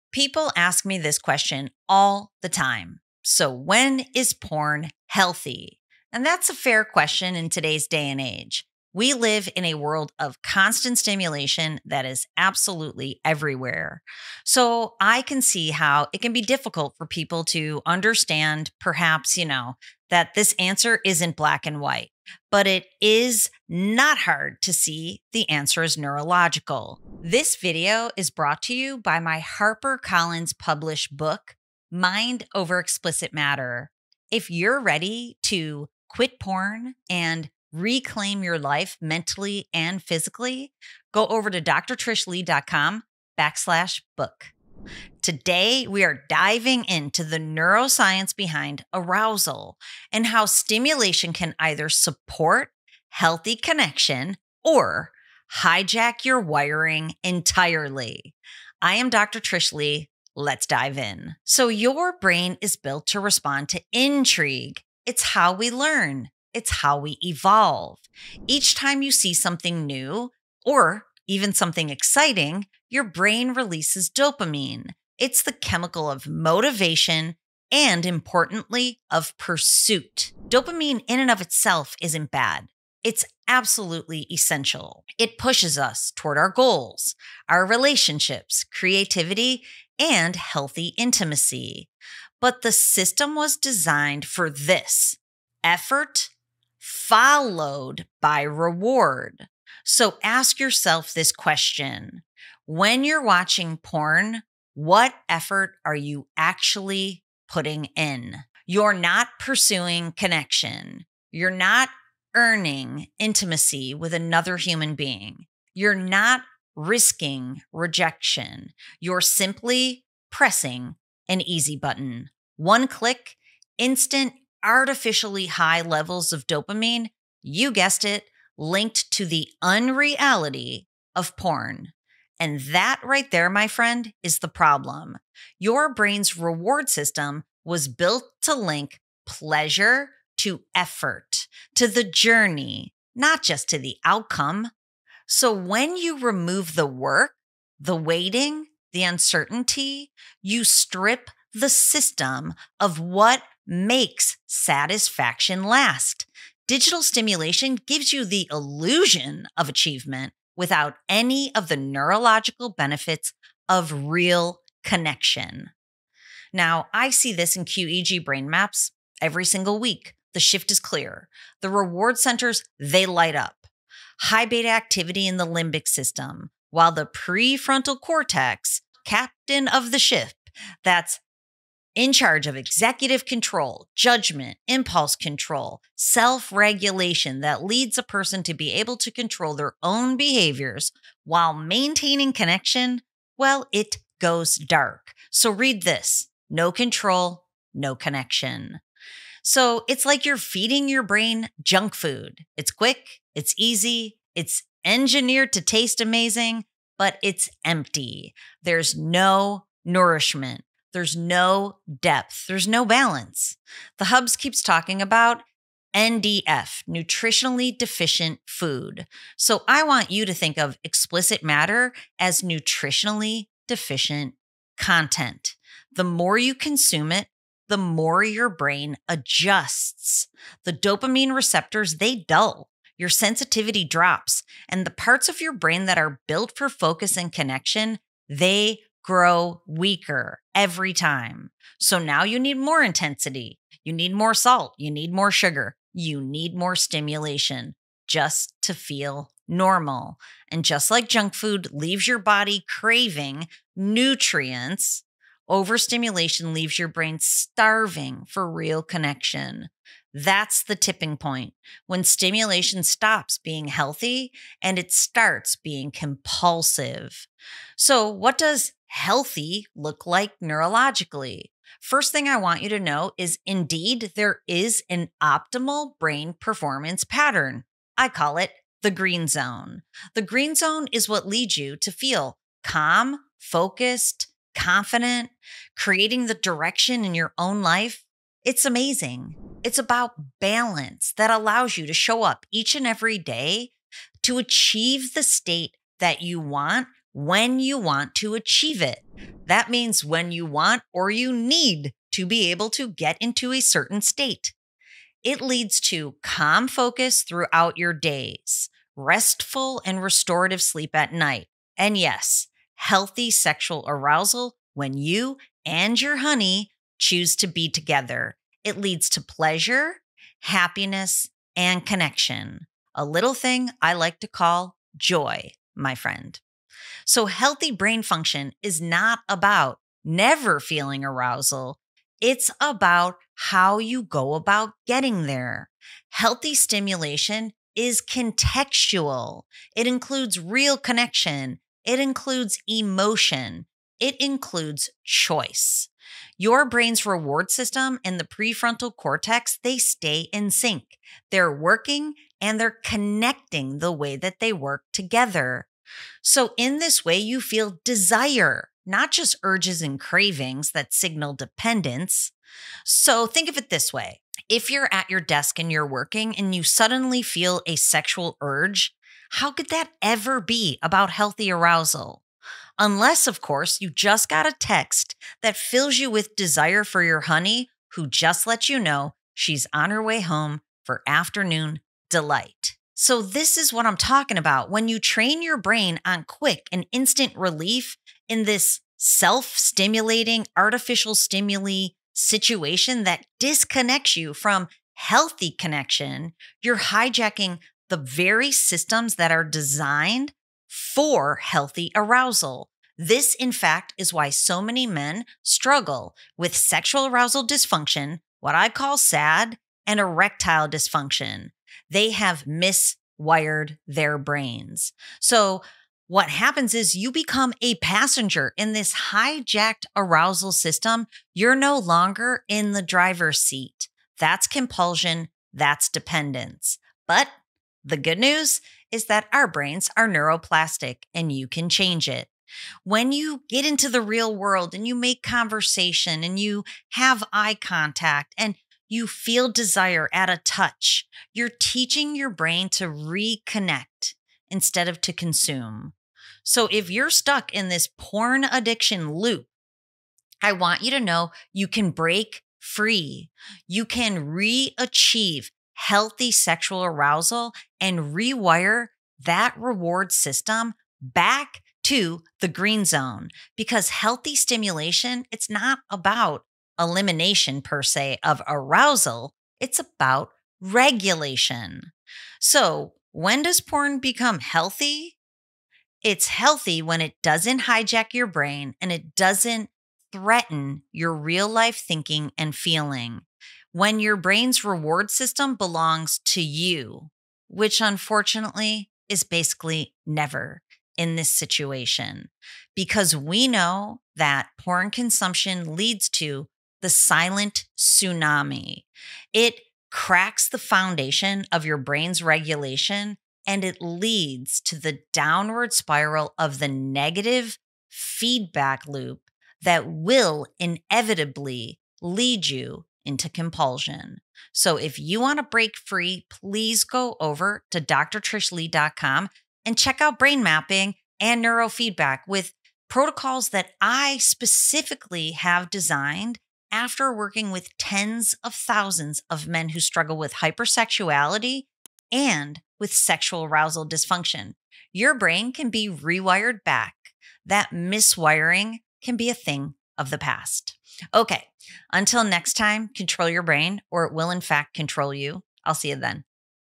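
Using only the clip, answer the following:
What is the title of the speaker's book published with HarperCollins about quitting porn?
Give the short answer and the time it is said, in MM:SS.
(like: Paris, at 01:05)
Mind Over Explicit Matter, at 00:31.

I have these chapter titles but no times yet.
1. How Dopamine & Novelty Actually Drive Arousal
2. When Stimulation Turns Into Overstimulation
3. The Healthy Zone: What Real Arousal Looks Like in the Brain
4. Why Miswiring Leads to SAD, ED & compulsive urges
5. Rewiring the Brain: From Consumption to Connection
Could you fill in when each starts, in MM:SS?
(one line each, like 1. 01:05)
1. 00:43
2. 02:04
3. 03:26
4. 04:58
5. 06:17.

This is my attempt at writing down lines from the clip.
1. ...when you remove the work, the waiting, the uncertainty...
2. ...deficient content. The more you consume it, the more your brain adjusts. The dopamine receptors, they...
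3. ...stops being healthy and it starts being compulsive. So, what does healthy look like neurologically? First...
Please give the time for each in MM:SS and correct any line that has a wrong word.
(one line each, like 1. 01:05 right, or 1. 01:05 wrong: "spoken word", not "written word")
1. 02:25 right
2. 03:43 right
3. 04:22 right.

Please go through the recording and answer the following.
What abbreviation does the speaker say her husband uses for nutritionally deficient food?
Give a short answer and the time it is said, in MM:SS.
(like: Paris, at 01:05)
NDF, at 03:35.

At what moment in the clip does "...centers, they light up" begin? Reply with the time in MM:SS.
02:52.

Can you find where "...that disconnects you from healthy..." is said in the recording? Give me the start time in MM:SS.
06:33.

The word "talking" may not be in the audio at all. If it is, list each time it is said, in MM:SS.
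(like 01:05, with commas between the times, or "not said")
03:34, 06:23.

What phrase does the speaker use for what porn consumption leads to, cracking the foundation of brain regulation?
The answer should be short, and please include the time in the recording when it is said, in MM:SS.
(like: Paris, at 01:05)
silent tsunami, at 08:16.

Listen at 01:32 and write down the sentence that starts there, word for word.
But the system was designed for this effort followed by reward.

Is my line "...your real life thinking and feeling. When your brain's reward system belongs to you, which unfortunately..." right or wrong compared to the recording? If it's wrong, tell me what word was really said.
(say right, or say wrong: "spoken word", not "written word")
right.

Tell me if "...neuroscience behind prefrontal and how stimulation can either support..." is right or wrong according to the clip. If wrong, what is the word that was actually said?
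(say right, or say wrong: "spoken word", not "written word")
wrong: "arousal", not "prefrontal".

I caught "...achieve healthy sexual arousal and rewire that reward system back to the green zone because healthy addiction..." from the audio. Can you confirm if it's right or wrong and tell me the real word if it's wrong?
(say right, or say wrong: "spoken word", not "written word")
wrong: "stimulation", not "addiction".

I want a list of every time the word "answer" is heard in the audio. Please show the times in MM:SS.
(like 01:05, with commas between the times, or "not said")
00:20, 00:25.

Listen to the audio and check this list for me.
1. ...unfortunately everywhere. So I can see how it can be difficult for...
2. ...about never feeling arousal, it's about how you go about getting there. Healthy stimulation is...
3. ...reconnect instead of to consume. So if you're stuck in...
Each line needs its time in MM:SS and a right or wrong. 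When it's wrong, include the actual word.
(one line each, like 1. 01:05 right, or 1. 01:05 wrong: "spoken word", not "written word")
1. 00:12 wrong: "absolutely", not "unfortunately"
2. 05:29 right
3. 07:22 right.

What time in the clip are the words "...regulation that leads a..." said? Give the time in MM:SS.
03:06.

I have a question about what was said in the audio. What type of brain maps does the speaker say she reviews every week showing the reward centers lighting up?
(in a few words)
QEEG.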